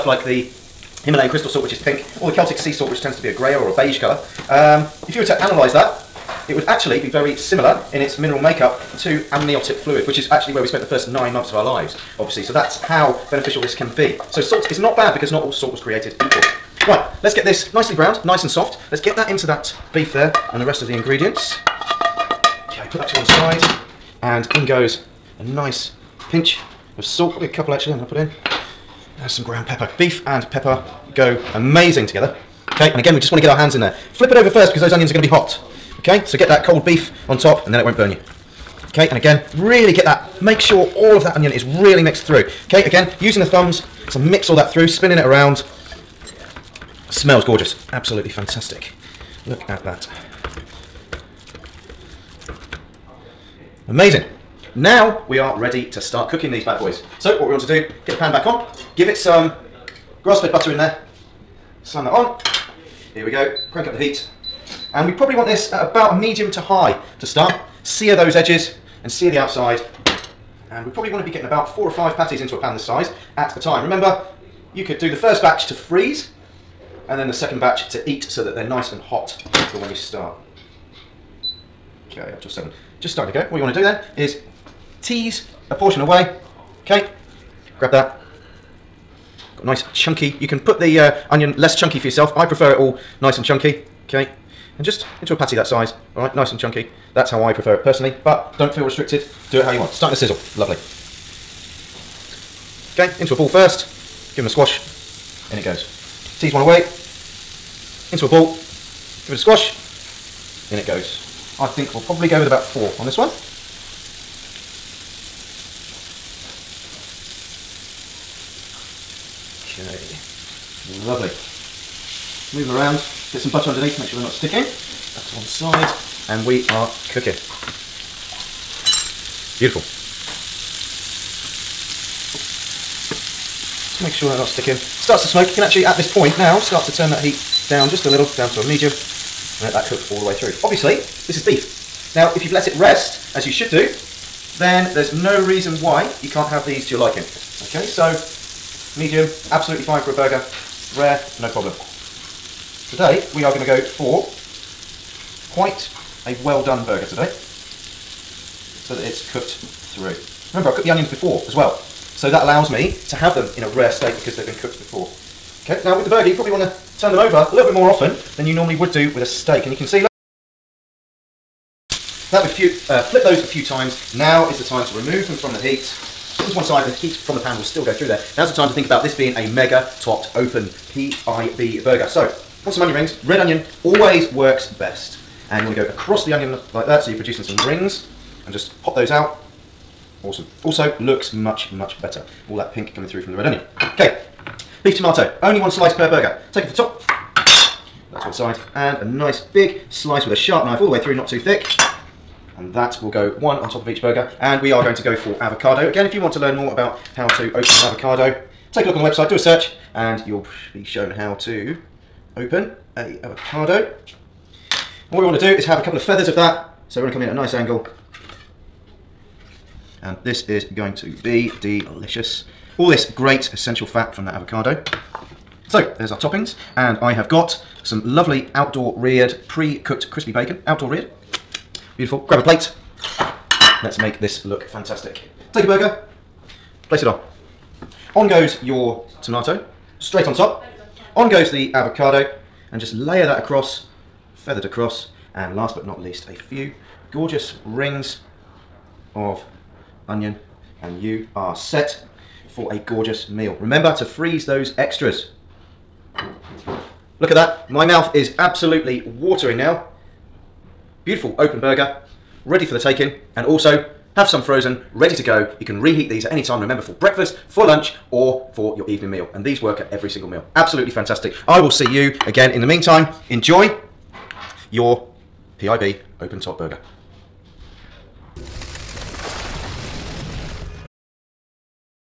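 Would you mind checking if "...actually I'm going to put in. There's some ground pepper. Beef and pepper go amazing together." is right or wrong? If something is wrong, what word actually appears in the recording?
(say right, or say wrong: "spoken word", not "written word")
right.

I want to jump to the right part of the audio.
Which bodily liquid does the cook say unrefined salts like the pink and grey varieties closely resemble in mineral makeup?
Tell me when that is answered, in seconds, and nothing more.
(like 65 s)
9 s.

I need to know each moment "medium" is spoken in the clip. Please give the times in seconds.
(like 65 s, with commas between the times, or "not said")
66 s, 138 s, 148 s.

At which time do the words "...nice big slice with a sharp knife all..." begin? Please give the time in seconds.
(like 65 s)
199 s.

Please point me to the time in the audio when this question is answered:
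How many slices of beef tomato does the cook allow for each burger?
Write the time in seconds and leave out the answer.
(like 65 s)
195 s.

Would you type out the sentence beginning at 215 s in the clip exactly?
And what we want to do is have a couple of feathers of that.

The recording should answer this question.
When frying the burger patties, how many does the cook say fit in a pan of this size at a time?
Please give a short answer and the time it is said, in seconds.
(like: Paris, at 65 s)
4 or 5, at 71 s.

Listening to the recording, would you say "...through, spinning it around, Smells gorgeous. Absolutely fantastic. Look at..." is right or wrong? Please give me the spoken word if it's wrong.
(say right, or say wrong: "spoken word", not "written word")
right.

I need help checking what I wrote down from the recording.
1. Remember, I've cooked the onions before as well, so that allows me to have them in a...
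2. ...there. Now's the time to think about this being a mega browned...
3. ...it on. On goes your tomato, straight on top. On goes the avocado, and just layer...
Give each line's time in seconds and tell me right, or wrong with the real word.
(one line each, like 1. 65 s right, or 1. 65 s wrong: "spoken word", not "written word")
1. 160 s right
2. 178 s wrong: "topped", not "browned"
3. 237 s right.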